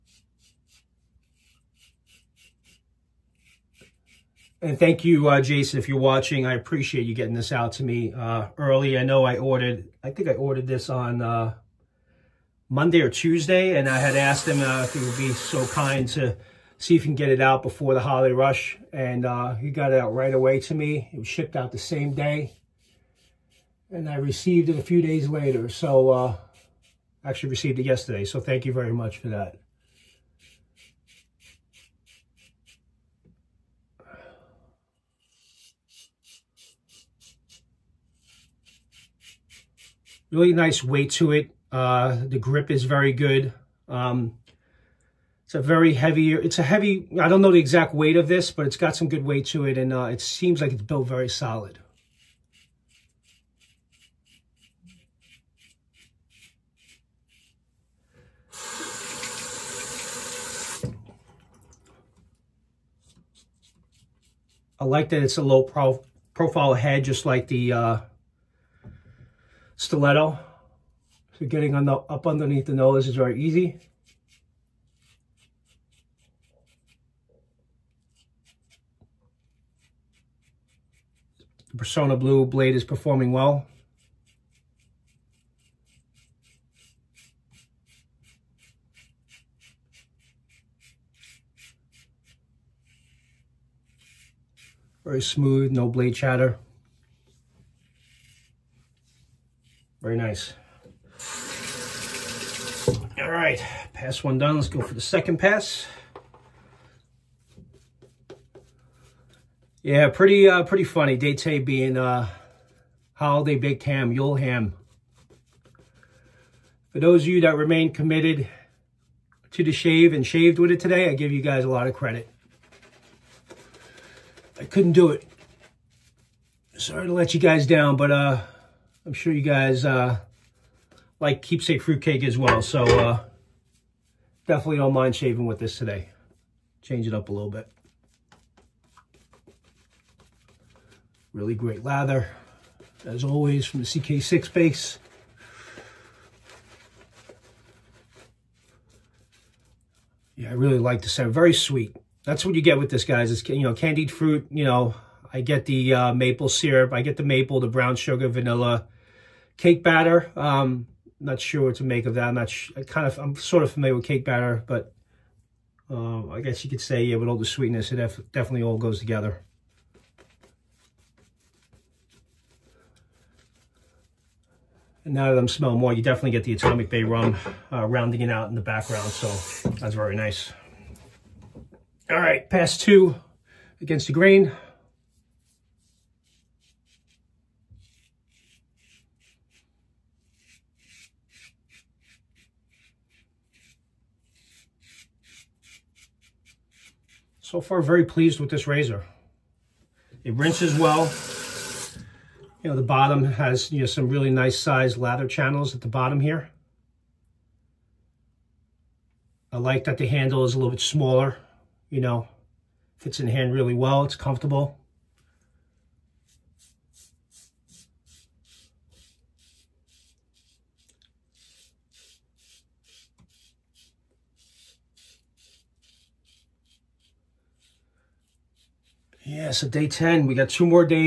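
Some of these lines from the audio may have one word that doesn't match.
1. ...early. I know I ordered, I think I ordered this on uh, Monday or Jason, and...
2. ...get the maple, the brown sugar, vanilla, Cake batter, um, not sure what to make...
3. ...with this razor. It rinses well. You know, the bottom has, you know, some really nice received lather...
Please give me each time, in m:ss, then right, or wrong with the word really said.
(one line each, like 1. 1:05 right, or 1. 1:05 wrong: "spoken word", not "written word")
1. 0:08 wrong: "Tuesday", not "Jason"
2. 2:37 right
3. 3:18 wrong: "sized", not "received".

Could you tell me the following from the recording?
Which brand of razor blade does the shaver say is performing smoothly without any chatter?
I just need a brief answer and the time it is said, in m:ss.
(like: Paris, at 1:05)
Personna Blue, at 1:21.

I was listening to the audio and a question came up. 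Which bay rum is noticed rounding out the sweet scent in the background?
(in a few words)
Atomic Bay rum.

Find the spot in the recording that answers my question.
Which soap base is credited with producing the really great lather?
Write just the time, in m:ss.
2:23.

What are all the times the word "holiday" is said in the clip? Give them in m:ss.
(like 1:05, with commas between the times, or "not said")
0:17, 1:53.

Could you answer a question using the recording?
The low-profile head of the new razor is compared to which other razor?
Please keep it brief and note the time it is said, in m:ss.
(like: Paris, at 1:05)
Stiletto, at 1:09.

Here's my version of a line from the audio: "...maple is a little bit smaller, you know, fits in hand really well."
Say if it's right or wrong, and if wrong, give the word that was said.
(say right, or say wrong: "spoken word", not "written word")
wrong: "handle", not "maple".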